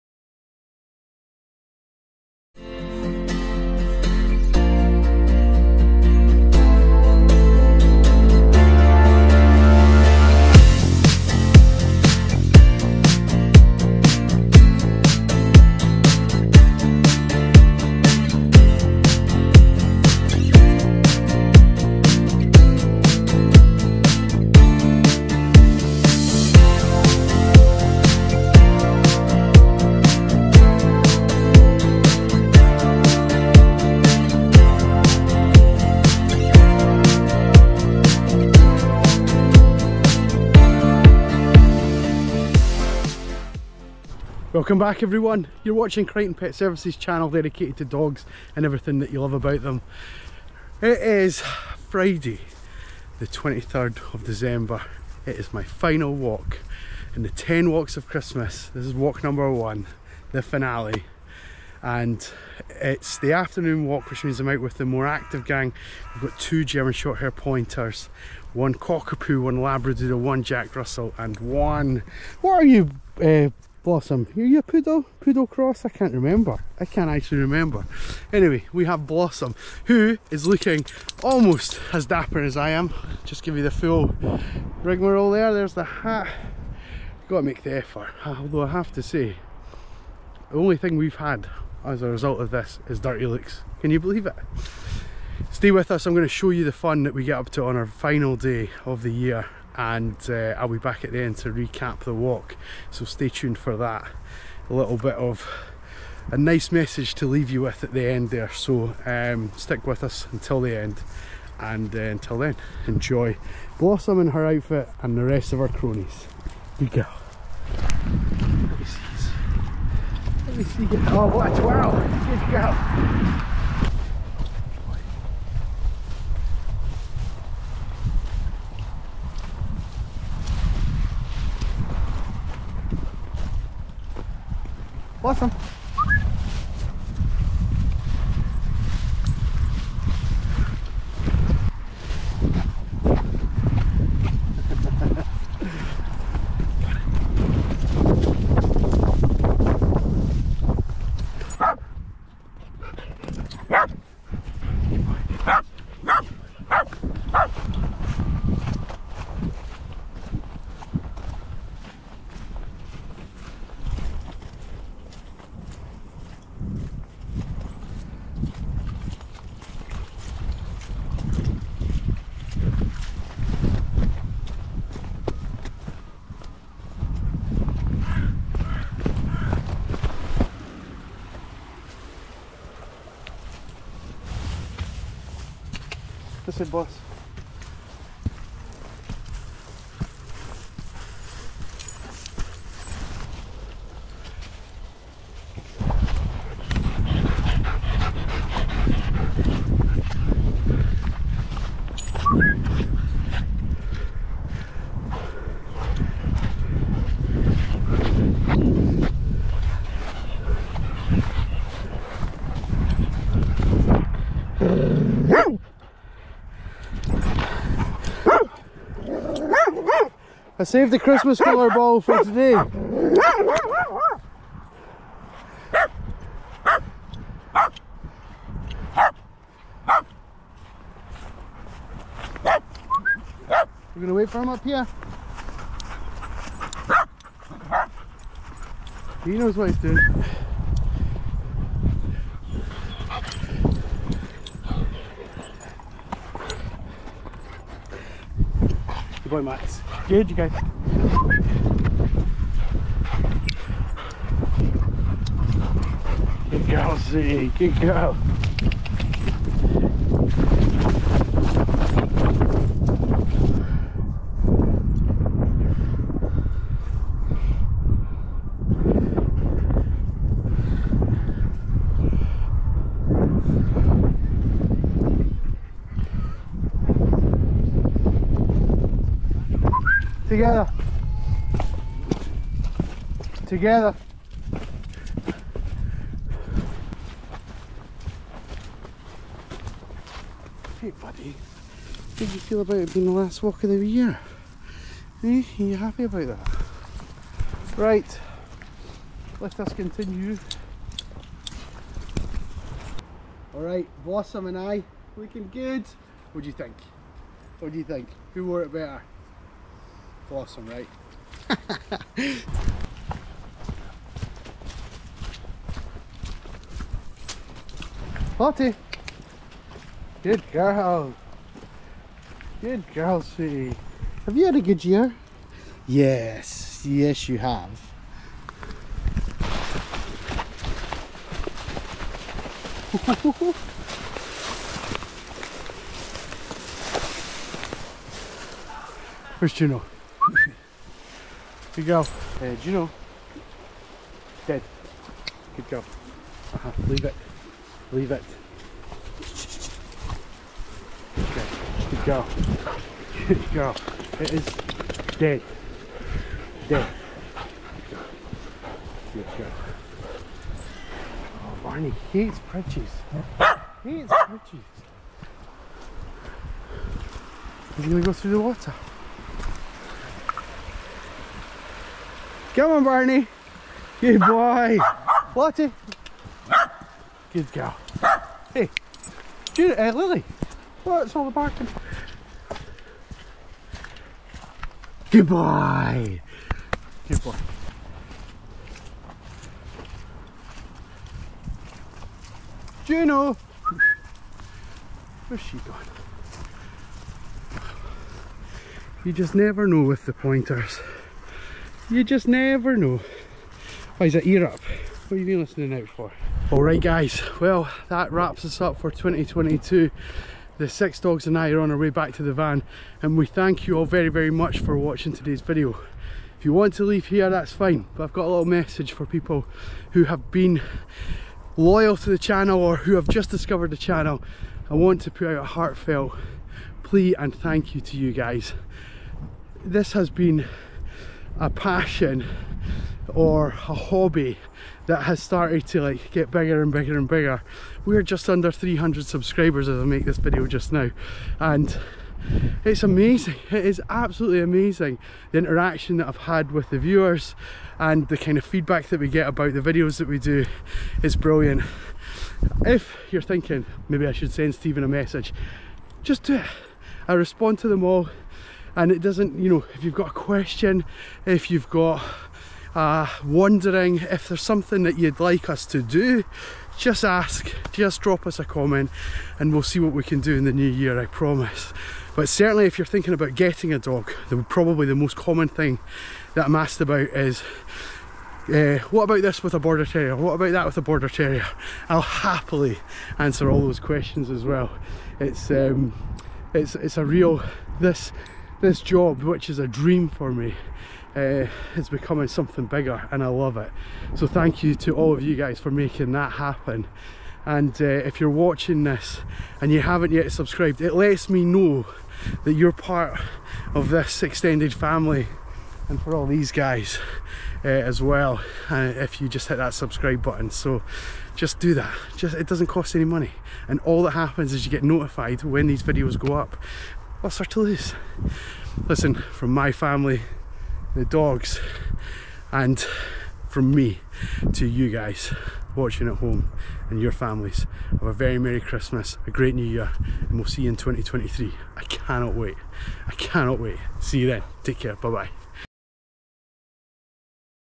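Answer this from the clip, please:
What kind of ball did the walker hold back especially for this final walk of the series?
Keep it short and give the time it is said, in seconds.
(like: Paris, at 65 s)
Christmas colour ball, at 220 s.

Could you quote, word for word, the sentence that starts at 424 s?
I want to put out a heartfelt plea and thank you to you guys.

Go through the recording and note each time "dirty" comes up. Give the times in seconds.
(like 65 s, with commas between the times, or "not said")
92 s.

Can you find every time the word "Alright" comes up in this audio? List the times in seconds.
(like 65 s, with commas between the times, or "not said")
303 s, 406 s.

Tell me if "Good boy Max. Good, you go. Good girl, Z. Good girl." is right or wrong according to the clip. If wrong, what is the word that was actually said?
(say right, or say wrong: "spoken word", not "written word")
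right.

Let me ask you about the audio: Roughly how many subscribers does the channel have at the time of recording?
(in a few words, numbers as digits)
Just under 300.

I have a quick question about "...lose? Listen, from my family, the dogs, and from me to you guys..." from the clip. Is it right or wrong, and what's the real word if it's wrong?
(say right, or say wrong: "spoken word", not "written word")
right.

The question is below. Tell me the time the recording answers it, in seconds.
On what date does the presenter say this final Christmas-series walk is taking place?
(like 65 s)
51 s.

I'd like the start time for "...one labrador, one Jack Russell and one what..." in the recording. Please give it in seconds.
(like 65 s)
69 s.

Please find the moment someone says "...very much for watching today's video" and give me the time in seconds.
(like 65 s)
414 s.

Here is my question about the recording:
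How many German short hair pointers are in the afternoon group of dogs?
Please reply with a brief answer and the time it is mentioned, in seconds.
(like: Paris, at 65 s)
2, at 66 s.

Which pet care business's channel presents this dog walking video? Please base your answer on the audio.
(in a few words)
Crighton Pet Services.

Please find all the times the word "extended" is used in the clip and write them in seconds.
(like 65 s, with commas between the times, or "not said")
504 s.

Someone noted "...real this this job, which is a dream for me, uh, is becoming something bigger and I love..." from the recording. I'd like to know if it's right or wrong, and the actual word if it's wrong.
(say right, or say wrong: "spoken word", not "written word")
right.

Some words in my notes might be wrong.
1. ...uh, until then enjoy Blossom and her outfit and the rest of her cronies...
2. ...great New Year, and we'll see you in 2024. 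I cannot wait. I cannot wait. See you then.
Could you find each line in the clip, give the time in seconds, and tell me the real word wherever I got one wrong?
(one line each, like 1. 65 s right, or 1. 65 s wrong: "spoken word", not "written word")
1. 111 s right
2. 529 s wrong: "2023", not "2024".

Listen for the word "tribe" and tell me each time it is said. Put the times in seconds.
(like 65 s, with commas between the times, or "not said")
not said.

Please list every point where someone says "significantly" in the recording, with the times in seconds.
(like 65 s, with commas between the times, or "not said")
not said.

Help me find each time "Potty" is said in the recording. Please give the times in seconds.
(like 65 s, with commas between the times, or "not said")
318 s.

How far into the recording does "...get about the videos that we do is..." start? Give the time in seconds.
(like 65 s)
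449 s.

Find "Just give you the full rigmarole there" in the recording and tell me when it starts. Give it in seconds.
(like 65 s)
83 s.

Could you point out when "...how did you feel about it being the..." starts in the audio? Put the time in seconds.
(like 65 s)
291 s.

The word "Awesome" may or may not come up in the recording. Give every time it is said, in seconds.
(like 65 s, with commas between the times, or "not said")
135 s, 310 s.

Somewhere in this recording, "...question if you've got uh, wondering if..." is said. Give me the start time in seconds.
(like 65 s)
460 s.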